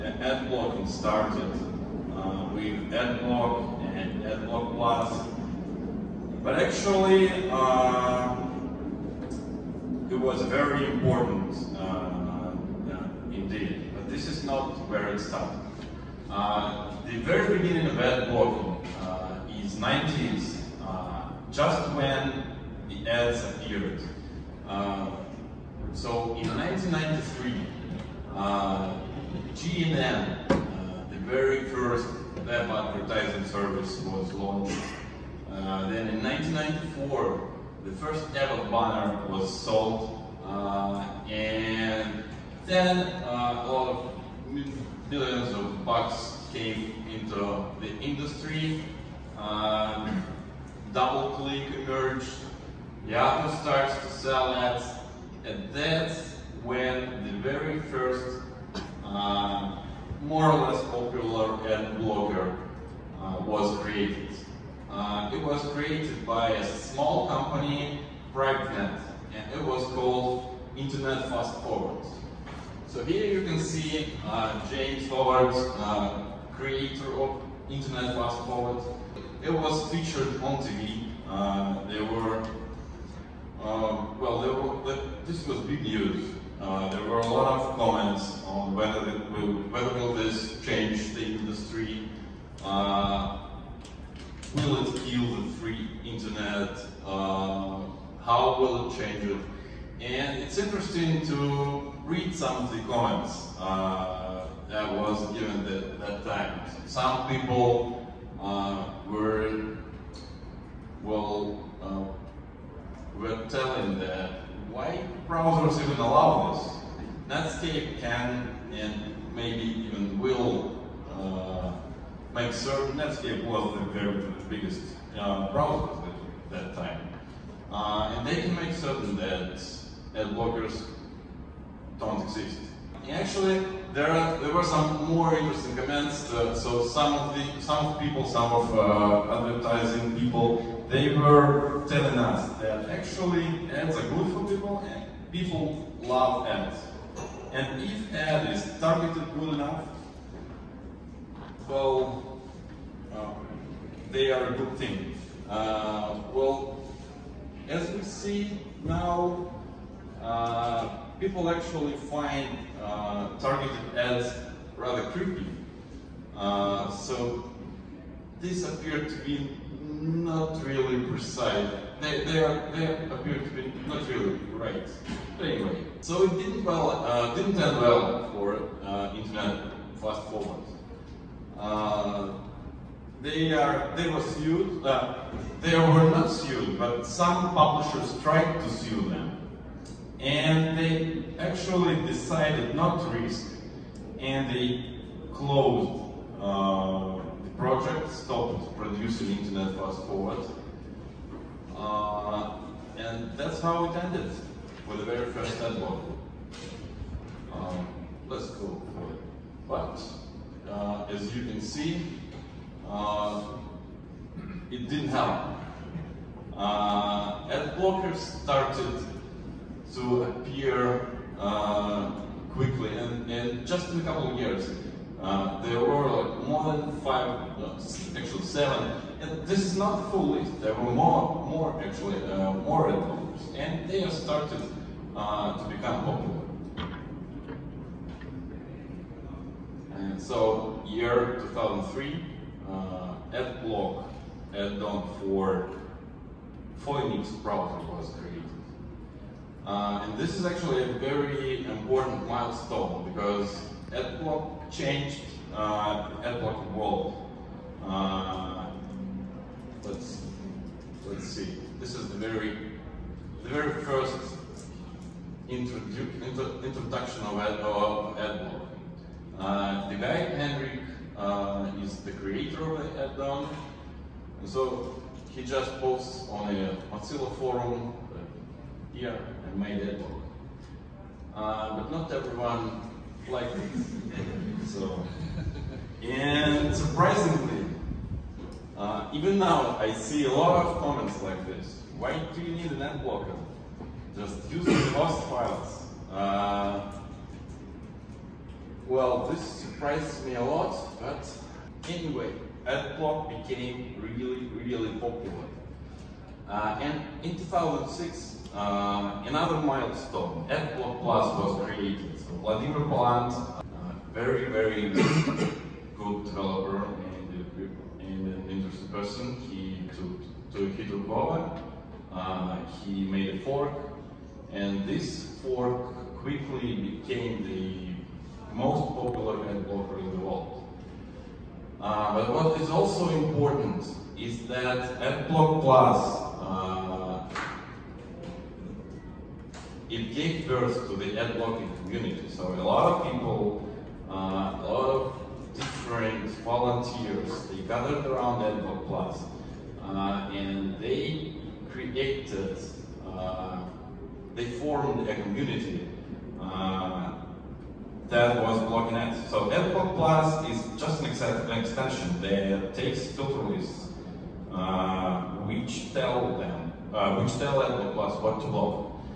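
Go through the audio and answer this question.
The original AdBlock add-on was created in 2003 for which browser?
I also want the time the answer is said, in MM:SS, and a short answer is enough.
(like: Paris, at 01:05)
Phoenix, at 04:06.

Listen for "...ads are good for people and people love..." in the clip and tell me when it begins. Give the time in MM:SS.
02:23.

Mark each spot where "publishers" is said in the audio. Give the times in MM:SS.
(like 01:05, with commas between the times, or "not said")
03:07.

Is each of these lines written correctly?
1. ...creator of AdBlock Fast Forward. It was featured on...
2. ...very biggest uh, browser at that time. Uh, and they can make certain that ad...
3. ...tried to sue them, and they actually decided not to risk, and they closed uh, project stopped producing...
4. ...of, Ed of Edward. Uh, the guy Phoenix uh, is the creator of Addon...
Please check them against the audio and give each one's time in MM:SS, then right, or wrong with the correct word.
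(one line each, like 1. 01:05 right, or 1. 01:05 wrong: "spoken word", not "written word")
1. 01:16 wrong: "Internet", not "AdBlock"
2. 02:03 right
3. 03:08 right
4. 04:27 wrong: "Henry", not "Phoenix".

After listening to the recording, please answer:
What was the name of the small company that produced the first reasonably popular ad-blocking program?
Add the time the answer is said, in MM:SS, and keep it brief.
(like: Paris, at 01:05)
PrivNet, at 01:08.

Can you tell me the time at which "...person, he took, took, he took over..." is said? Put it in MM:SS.
05:18.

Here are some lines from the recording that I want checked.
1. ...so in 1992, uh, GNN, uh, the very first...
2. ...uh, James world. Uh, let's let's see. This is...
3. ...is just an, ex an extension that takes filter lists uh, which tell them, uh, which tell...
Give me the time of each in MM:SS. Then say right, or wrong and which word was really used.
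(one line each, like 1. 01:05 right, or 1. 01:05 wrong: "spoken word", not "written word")
1. 00:25 wrong: "1993", not "1992"
2. 04:15 wrong: "Edward", not "James"
3. 06:00 right.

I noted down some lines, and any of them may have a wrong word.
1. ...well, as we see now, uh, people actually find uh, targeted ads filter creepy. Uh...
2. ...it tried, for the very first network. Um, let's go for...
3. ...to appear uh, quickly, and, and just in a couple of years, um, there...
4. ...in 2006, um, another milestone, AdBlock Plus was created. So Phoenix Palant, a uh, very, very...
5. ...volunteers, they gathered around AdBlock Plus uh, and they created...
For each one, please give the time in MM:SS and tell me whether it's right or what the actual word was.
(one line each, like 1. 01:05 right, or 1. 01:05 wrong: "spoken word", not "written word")
1. 02:36 wrong: "rather", not "filter"
2. 03:23 wrong: "ended", not "tried"
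3. 03:39 right
4. 05:07 wrong: "Wladimir", not "Phoenix"
5. 05:46 right.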